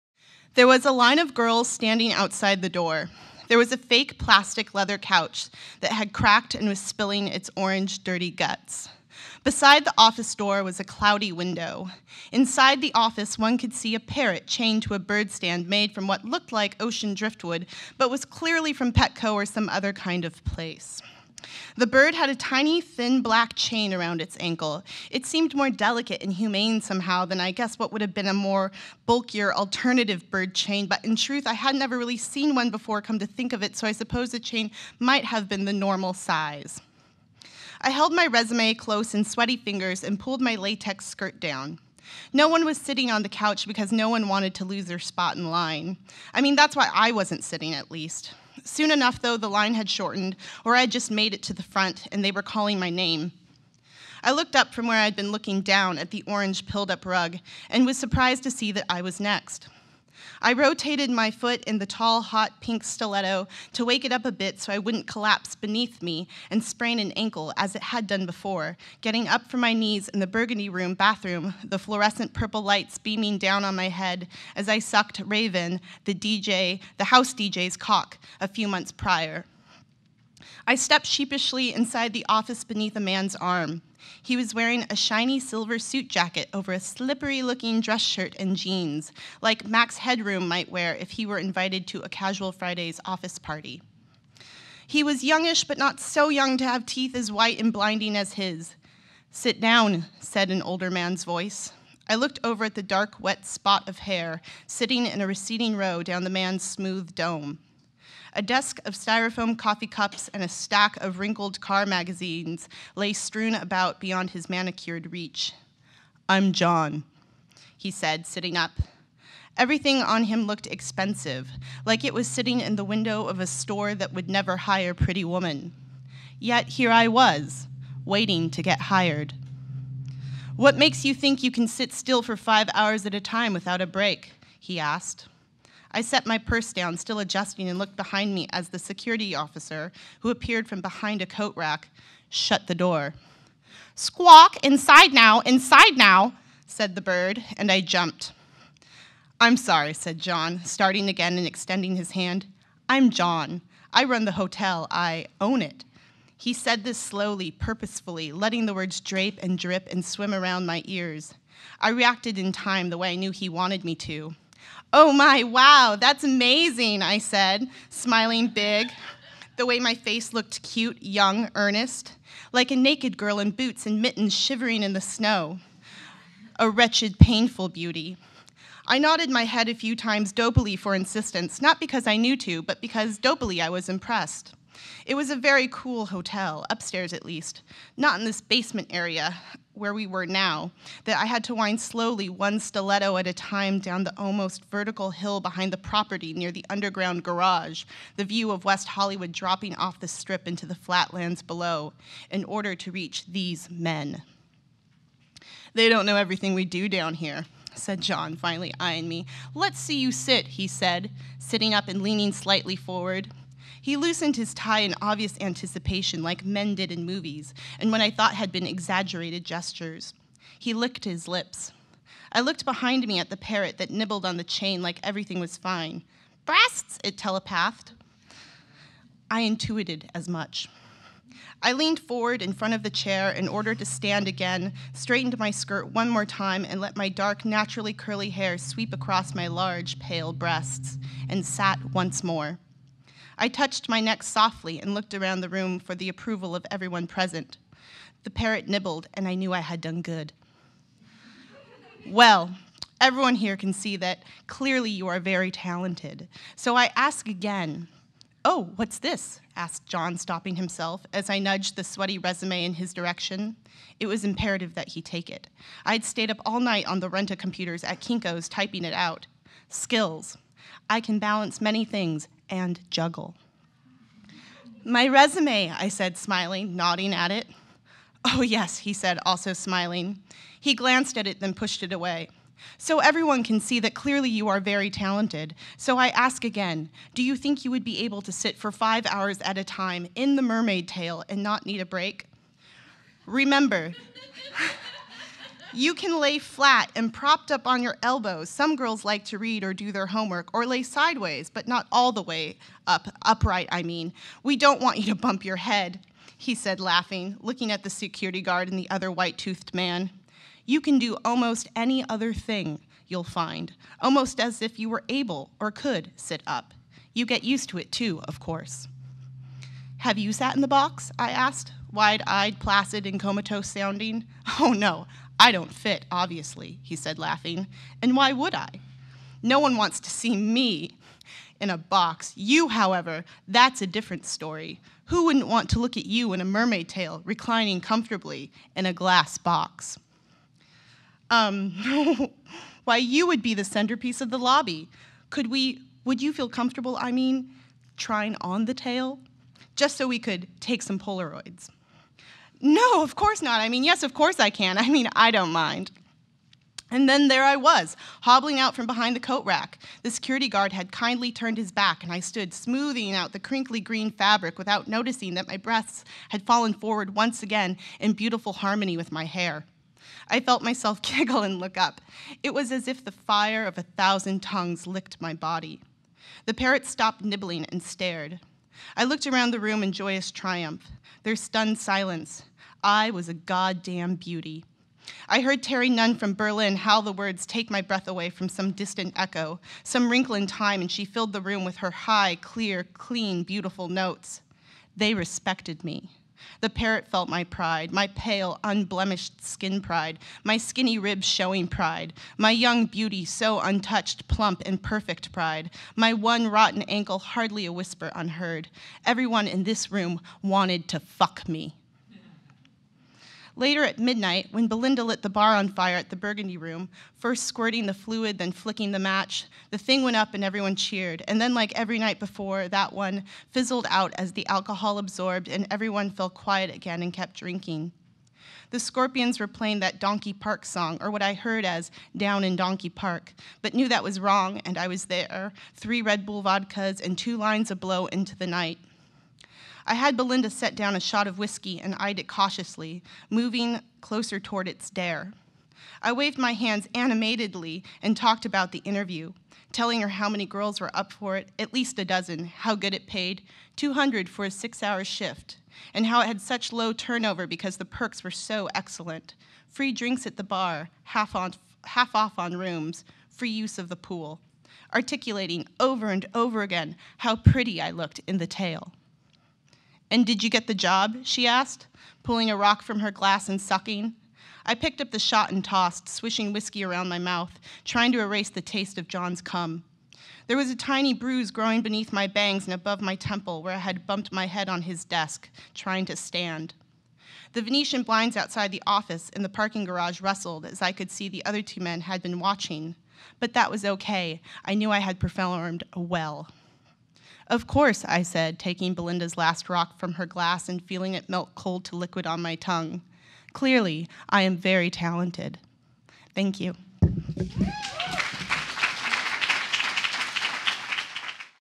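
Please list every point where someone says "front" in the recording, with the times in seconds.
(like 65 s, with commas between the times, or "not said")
51 s, 232 s.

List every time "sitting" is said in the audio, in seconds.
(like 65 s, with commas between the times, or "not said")
42 s, 47 s, 104 s, 118 s, 122 s, 211 s.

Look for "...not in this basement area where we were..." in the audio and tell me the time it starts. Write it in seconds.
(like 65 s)
187 s.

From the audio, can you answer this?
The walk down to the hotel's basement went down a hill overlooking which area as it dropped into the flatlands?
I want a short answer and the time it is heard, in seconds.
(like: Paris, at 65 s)
West Hollywood, at 198 s.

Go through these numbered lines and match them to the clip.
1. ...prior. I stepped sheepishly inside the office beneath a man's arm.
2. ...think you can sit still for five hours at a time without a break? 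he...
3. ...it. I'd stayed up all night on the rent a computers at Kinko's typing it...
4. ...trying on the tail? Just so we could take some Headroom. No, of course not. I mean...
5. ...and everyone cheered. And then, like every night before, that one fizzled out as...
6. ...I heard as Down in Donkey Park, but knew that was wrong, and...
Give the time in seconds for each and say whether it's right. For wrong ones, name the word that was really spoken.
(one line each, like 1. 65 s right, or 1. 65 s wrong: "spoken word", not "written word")
1. 78 s right
2. 131 s right
3. 265 s right
4. 347 s wrong: "Polaroids", not "Headroom"
5. 420 s right
6. 431 s right.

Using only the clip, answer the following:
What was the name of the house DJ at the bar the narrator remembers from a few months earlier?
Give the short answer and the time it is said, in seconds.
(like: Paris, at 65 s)
Raven, at 75 s.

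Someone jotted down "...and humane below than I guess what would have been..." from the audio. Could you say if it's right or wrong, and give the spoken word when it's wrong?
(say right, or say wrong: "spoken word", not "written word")
wrong: "somehow", not "below".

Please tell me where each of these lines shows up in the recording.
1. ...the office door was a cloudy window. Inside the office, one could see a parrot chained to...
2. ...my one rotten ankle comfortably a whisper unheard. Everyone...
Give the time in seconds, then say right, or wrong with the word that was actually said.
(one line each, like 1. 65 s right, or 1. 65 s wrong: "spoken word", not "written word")
1. 9 s right
2. 405 s wrong: "hardly", not "comfortably".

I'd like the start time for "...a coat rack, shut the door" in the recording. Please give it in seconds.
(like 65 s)
141 s.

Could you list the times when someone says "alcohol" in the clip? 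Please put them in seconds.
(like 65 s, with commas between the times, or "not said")
424 s.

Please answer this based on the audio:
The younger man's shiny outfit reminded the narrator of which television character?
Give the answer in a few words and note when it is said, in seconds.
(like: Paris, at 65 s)
Max Headroom, at 89 s.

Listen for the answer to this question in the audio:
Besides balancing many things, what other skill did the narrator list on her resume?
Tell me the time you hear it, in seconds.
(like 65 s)
272 s.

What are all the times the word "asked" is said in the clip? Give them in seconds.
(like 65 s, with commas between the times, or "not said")
134 s, 259 s, 321 s, 471 s.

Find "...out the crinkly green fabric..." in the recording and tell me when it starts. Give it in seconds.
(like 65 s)
363 s.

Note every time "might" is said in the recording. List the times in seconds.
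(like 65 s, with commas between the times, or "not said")
34 s, 90 s.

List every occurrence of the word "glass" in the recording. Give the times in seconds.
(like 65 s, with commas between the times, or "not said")
338 s, 473 s, 500 s.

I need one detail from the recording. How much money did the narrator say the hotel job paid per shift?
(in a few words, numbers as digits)
200.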